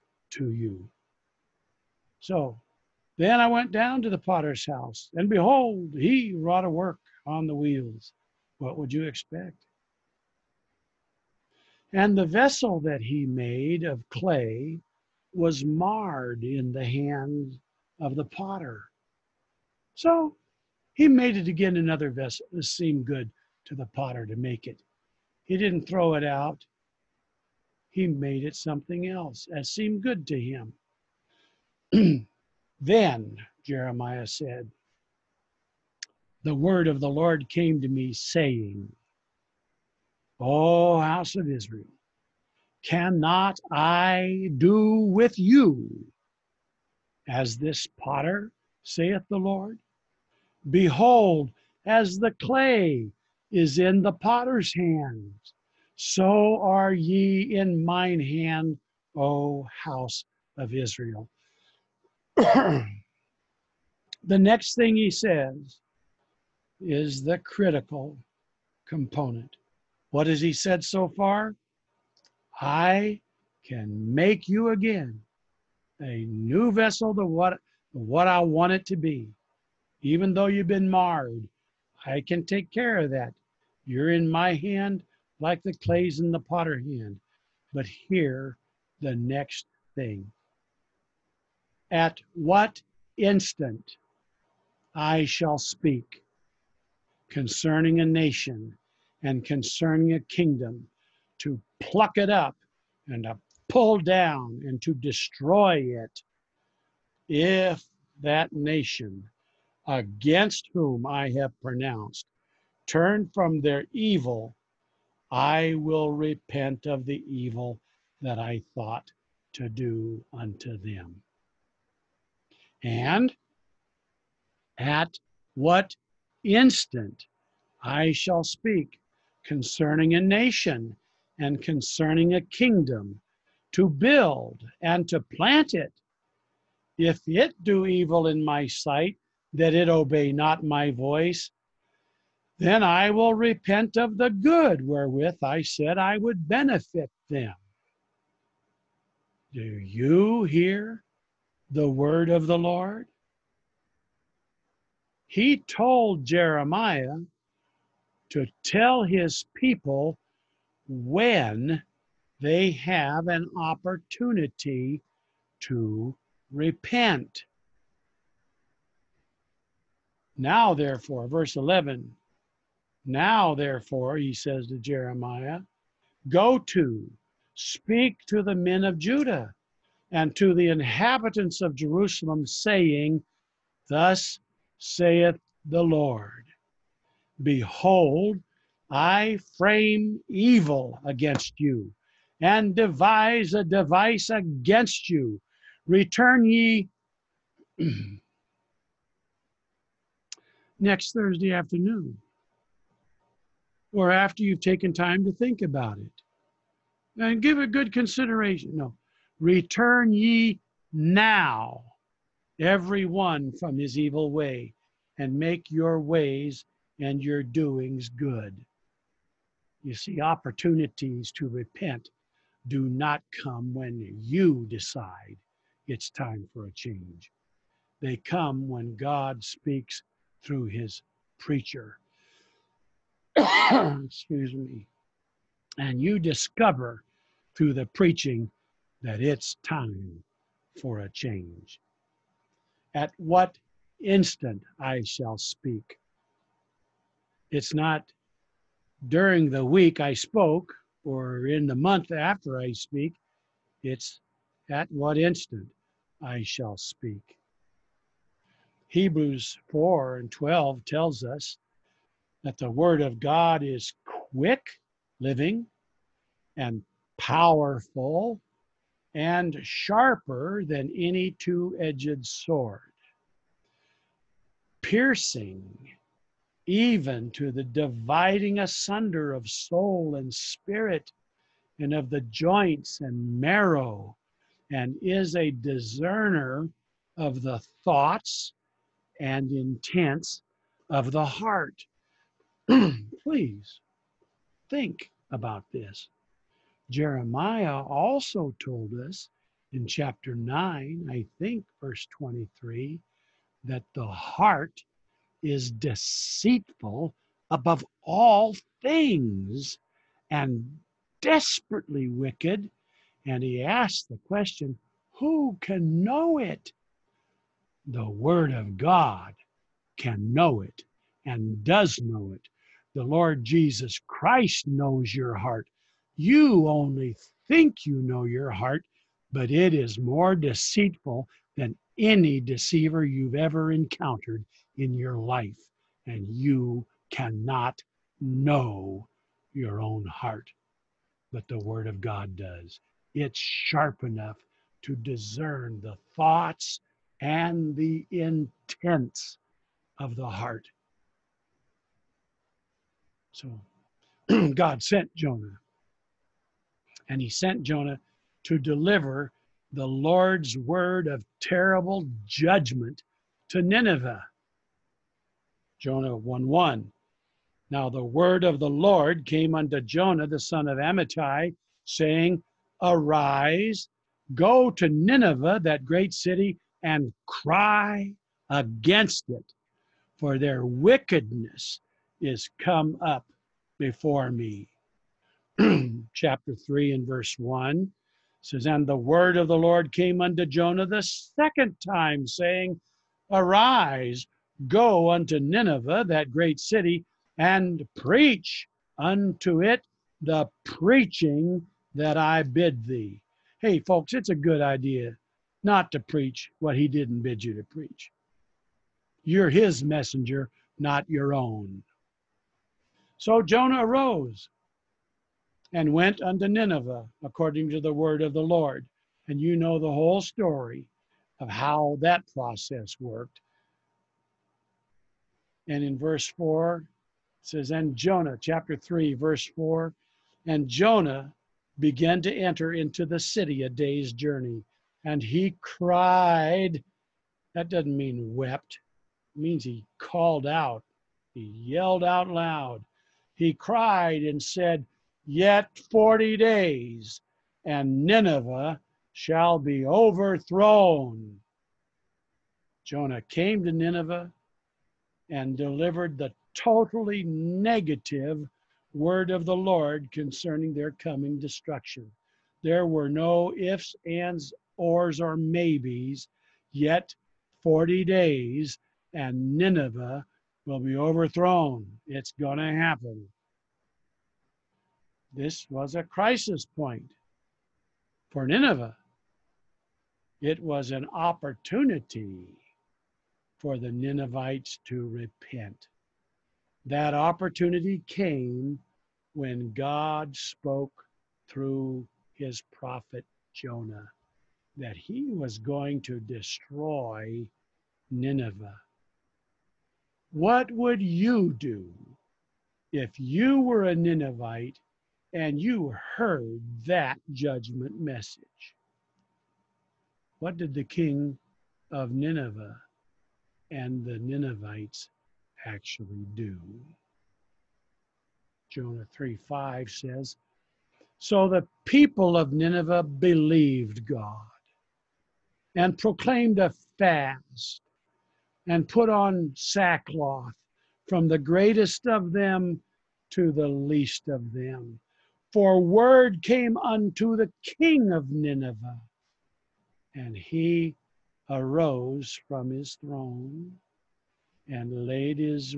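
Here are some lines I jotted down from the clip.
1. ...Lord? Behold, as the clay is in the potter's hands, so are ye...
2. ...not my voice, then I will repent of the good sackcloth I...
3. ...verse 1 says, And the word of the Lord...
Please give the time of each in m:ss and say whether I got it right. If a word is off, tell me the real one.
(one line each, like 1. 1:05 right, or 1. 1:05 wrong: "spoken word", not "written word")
1. 0:49 right
2. 2:20 wrong: "wherewith", not "sackcloth"
3. 6:27 right.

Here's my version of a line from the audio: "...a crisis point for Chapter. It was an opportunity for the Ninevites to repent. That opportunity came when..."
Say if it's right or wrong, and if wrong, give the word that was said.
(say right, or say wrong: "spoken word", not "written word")
wrong: "Nineveh", not "Chapter".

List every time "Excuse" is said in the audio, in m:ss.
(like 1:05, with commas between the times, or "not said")
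3:53.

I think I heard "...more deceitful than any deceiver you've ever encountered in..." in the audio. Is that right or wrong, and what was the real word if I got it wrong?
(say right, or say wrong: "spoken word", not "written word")
right.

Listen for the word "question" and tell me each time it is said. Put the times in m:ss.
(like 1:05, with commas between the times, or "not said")
5:14.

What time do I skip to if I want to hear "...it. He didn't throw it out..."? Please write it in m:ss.
0:24.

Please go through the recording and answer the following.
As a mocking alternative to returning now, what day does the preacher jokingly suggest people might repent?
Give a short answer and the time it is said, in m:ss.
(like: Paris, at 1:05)
Thursday afternoon, at 3:21.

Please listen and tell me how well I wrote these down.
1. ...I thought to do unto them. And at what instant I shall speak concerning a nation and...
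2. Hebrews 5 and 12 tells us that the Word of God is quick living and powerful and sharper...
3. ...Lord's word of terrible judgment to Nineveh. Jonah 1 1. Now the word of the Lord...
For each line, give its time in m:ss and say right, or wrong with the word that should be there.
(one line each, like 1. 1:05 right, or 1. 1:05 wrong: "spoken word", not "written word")
1. 1:58 right
2. 4:18 wrong: "4", not "5"
3. 5:59 right.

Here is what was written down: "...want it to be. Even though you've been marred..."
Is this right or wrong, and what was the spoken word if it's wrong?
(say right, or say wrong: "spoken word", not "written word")
right.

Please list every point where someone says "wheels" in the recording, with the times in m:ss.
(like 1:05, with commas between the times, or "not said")
0:07.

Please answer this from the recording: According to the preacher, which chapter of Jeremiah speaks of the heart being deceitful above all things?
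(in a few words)
Chapter 9.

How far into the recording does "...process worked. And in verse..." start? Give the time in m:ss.
7:02.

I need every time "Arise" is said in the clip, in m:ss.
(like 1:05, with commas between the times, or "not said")
6:12, 6:33.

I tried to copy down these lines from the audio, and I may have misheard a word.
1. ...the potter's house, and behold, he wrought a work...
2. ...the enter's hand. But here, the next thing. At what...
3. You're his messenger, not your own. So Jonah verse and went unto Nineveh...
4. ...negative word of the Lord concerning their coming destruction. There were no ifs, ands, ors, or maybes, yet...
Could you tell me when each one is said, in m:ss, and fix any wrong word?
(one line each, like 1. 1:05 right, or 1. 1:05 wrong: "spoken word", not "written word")
1. 0:04 right
2. 1:26 wrong: "potter", not "enter"
3. 6:49 wrong: "arose", not "verse"
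4. 7:37 right.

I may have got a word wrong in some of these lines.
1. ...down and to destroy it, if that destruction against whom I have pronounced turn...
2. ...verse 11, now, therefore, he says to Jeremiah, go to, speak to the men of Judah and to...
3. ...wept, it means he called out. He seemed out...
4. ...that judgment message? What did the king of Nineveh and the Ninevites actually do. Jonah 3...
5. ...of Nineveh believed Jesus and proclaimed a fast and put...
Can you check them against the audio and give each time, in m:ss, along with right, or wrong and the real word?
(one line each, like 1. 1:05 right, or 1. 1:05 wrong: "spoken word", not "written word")
1. 1:43 wrong: "nation", not "destruction"
2. 2:51 right
3. 7:18 wrong: "yelled", not "seemed"
4. 8:26 right
5. 8:42 wrong: "God", not "Jesus".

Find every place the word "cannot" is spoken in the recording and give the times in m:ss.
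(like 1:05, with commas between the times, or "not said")
0:42, 5:37.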